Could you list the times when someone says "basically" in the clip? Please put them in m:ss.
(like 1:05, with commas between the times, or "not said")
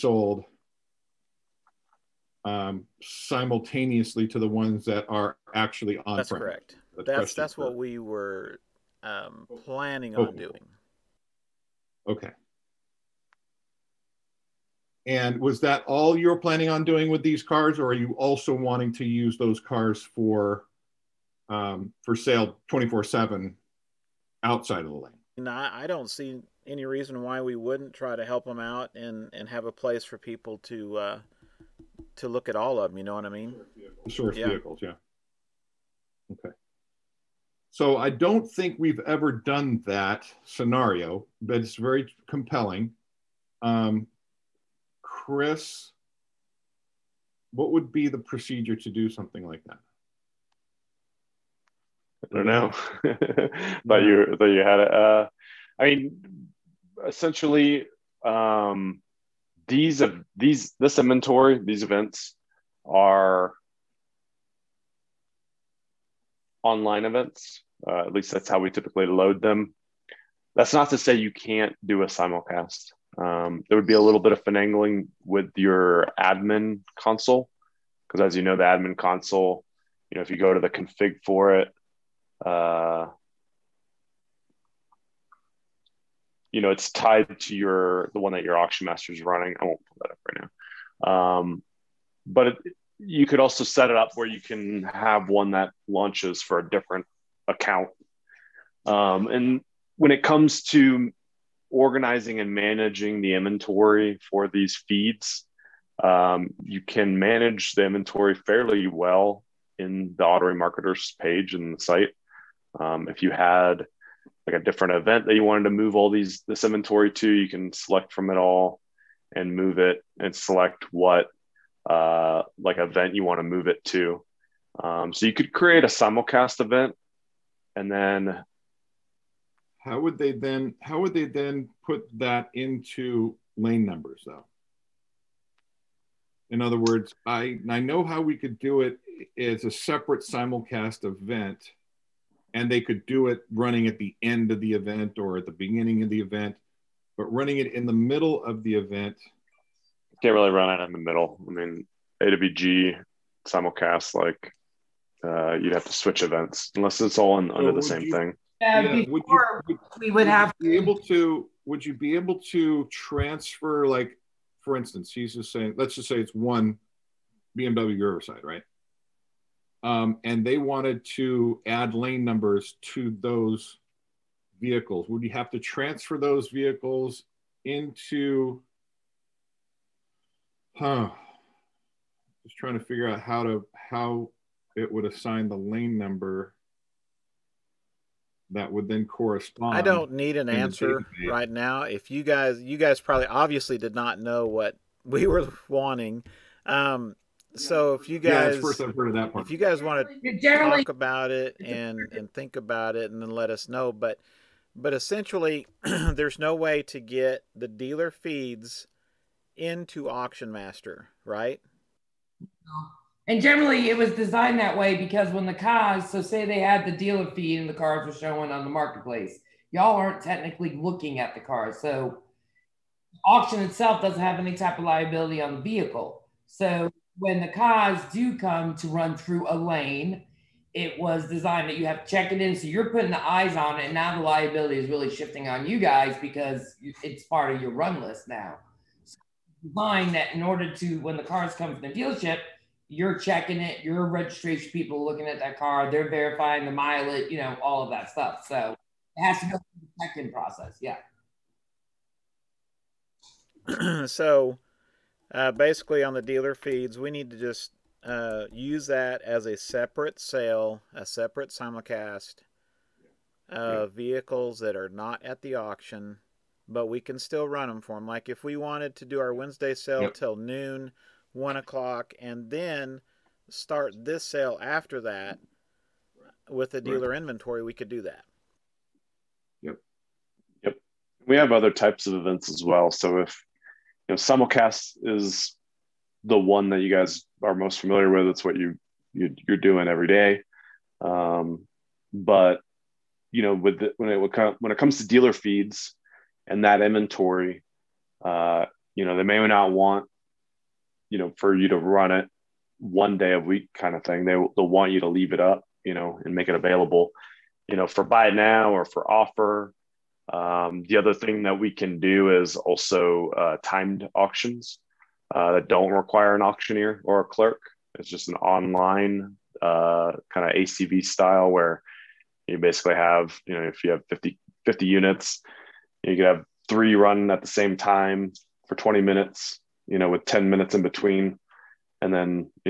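4:15, 5:22.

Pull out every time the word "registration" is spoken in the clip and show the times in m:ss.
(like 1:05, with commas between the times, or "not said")
4:04.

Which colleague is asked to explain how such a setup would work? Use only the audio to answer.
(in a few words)
Chris.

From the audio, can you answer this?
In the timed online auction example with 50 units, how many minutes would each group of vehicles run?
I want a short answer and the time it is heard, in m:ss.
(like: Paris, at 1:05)
20 minutes, at 5:28.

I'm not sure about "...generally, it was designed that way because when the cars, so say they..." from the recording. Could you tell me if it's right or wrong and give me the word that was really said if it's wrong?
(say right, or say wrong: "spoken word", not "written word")
right.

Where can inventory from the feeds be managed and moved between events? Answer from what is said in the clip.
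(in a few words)
Auto Marketers.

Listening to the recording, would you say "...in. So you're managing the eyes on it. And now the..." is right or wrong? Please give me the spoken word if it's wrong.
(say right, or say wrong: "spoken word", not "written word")
wrong: "putting", not "managing".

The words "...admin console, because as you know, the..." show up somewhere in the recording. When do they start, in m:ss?
1:16.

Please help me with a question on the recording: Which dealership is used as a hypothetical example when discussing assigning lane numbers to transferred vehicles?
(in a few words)
BMW Riverside.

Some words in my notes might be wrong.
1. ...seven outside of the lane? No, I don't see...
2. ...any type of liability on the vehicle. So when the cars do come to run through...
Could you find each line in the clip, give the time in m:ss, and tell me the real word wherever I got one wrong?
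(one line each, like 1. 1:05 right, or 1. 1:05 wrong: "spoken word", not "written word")
1. 0:23 right
2. 3:44 right.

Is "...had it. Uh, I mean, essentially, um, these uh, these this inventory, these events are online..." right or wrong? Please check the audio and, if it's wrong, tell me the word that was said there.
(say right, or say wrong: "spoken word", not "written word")
right.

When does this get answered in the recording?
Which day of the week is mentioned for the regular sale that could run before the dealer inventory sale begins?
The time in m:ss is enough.
4:29.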